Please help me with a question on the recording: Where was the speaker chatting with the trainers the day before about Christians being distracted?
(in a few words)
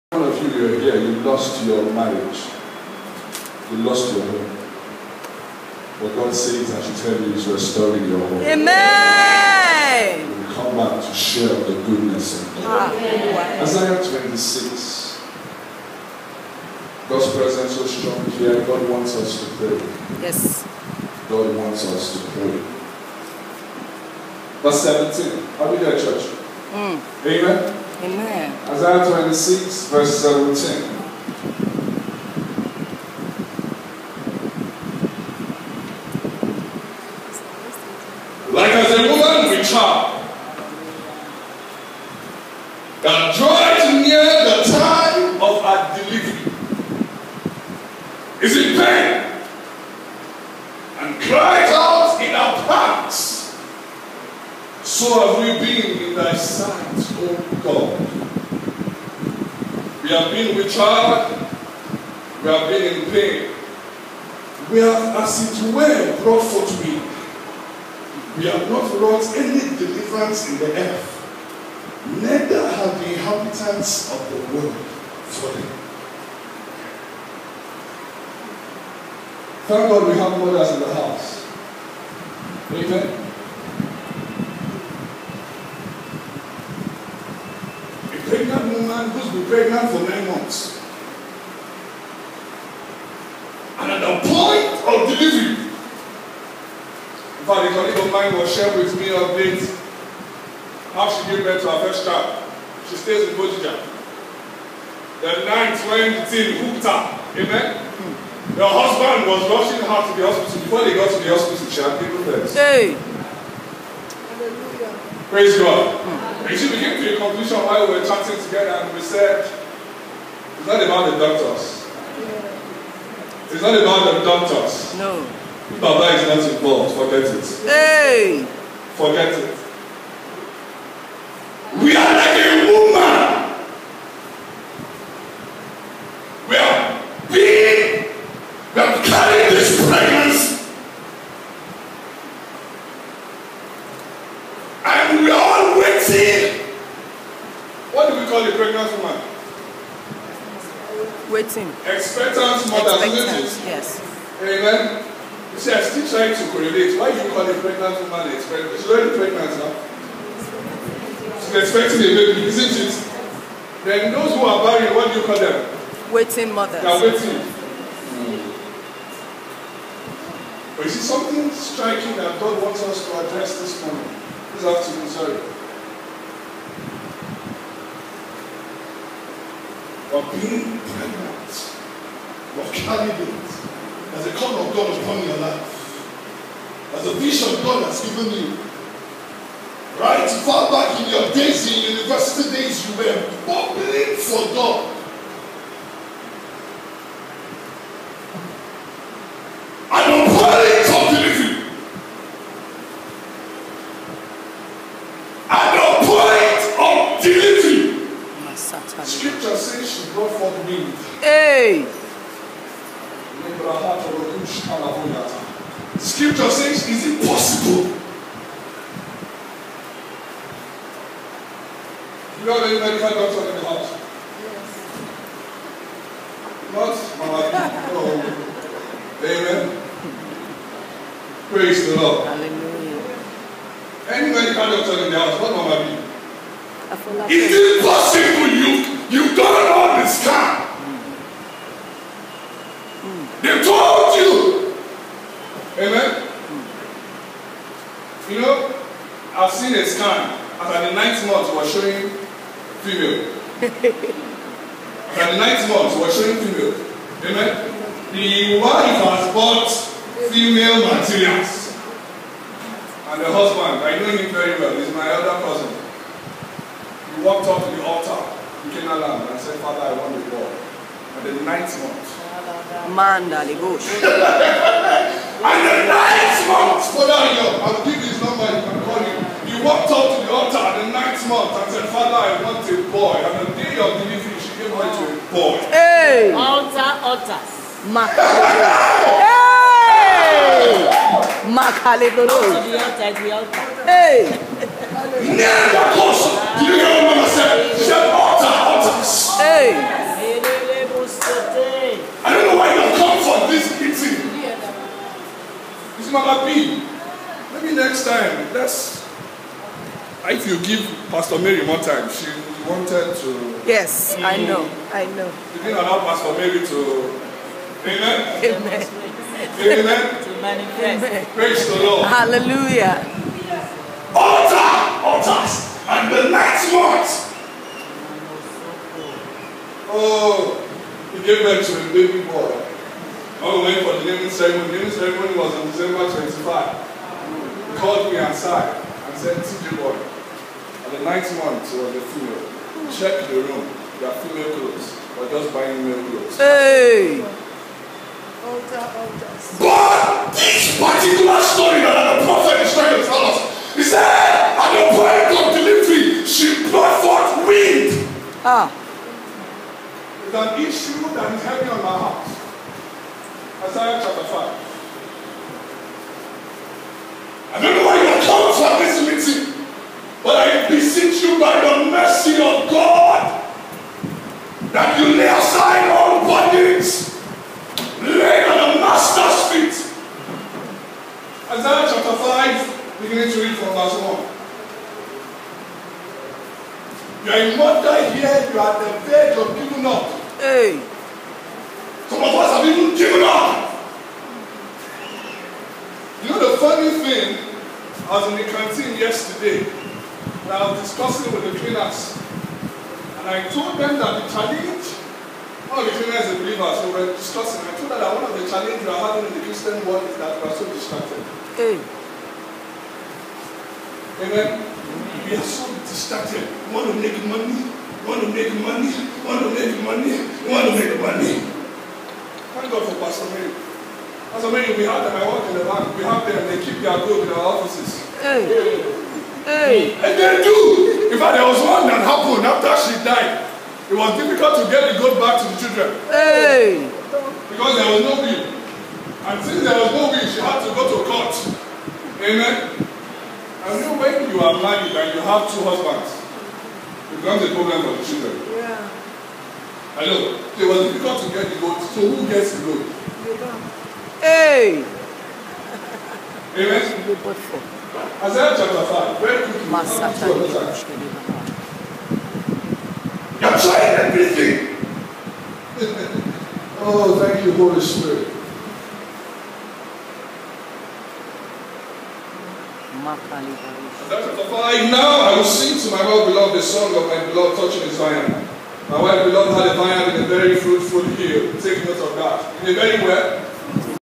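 The canteen.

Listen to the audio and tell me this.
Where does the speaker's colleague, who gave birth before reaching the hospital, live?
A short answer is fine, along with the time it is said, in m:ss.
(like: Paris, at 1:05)
Bojija, at 1:43.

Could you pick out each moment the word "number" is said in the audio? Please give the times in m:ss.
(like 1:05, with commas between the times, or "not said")
4:38.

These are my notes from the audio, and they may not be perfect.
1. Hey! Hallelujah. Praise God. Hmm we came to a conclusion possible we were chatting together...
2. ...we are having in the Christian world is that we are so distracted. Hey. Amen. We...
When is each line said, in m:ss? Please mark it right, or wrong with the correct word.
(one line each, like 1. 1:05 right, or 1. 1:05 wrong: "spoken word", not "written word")
1. 1:52 wrong: "while", not "possible"
2. 6:48 right.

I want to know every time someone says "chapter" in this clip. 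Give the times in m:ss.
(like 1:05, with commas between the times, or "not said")
6:04, 6:21, 7:38.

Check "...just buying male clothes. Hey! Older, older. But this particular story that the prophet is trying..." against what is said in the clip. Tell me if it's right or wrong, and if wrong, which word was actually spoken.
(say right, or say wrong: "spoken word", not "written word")
right.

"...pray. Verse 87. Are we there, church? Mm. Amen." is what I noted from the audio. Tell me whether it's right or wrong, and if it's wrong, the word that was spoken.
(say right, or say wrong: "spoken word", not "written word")
wrong: "17", not "87".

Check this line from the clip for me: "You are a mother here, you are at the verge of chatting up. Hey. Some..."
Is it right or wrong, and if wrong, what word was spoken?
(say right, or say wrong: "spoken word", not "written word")
wrong: "giving", not "chatting".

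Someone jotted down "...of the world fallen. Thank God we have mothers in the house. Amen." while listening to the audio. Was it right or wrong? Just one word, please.
right.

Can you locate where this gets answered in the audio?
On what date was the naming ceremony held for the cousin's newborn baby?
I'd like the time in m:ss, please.
5:35.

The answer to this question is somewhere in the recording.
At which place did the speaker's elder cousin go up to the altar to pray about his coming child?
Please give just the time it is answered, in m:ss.
4:28.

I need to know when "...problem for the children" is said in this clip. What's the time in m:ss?
7:27.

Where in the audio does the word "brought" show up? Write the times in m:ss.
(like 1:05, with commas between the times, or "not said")
1:06, 5:56.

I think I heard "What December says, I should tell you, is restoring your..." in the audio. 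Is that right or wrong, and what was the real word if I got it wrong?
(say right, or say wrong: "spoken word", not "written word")
wrong: "God", not "December".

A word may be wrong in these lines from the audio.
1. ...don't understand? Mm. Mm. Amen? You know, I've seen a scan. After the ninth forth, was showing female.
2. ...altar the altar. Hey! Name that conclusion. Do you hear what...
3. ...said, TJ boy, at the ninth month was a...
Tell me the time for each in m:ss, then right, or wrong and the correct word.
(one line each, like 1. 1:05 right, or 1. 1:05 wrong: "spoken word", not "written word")
1. 3:59 wrong: "month", not "forth"
2. 4:52 wrong: "person", not "conclusion"
3. 5:39 right.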